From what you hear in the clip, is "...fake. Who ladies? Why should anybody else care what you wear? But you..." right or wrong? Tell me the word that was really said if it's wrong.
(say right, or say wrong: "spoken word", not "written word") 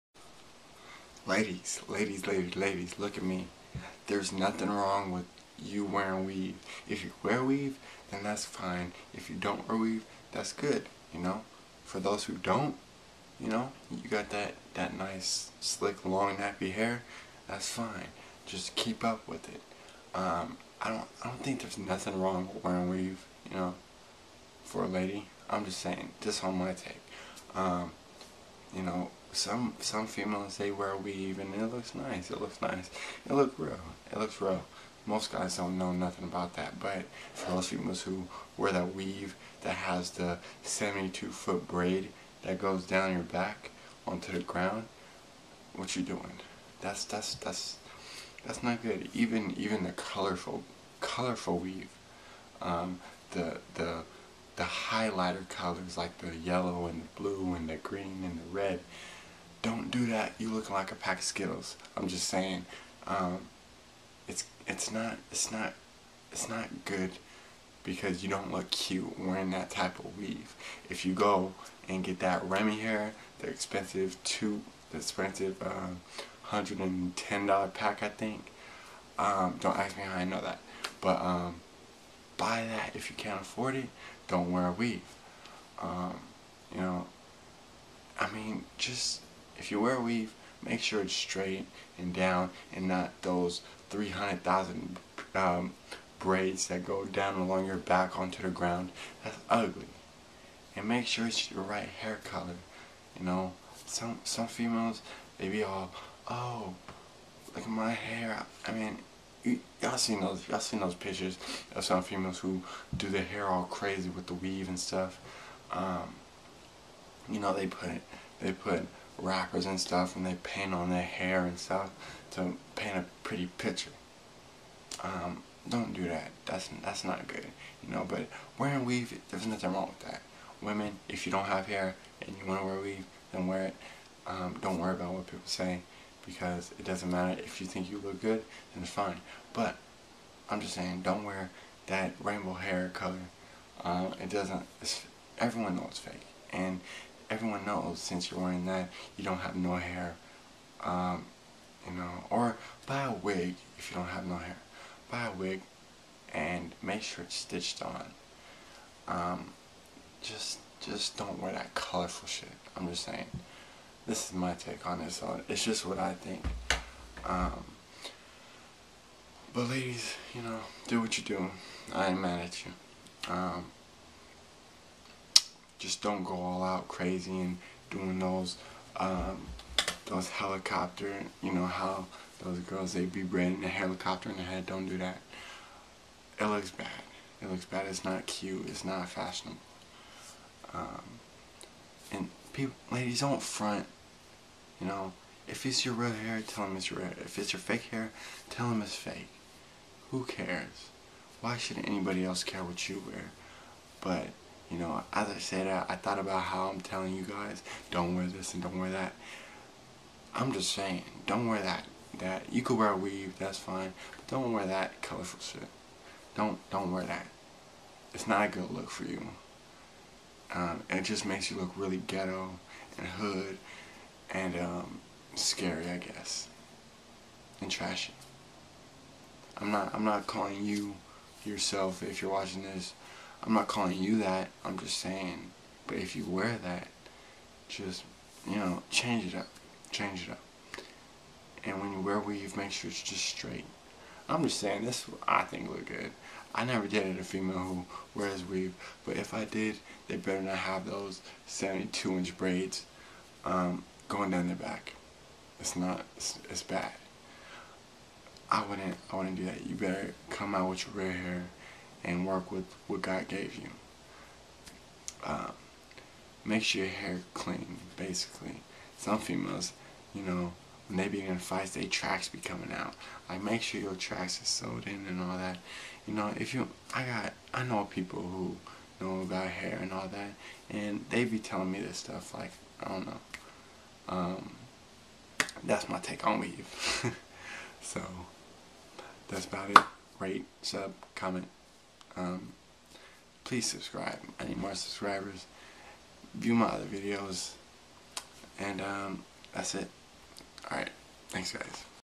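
wrong: "cares", not "ladies".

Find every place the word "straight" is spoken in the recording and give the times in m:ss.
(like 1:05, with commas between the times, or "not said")
1:31, 4:03.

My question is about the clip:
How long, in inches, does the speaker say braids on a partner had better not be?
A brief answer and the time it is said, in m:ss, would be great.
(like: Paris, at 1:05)
72, at 4:11.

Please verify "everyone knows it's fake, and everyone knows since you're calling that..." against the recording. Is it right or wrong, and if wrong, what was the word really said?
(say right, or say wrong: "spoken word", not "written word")
wrong: "wearing", not "calling".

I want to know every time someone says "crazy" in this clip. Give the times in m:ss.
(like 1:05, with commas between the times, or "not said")
1:53, 2:56.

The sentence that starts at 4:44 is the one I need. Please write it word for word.
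Um, that's my take on weave.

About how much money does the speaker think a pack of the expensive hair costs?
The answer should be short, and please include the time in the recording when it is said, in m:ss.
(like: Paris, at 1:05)
$110, at 1:16.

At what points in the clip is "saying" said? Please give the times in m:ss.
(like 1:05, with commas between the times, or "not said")
0:25, 1:02, 2:20, 2:43, 3:30, 3:54, 4:04.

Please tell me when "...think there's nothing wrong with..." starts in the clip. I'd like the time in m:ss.
0:21.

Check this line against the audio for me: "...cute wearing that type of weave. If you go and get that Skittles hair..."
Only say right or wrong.
wrong.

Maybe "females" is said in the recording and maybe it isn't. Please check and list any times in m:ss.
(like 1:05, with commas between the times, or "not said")
0:30, 0:37, 1:44, 1:52, 4:07, 4:29.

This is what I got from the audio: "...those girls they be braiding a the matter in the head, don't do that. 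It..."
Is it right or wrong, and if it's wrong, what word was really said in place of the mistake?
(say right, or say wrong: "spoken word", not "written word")
wrong: "helicopter", not "matter".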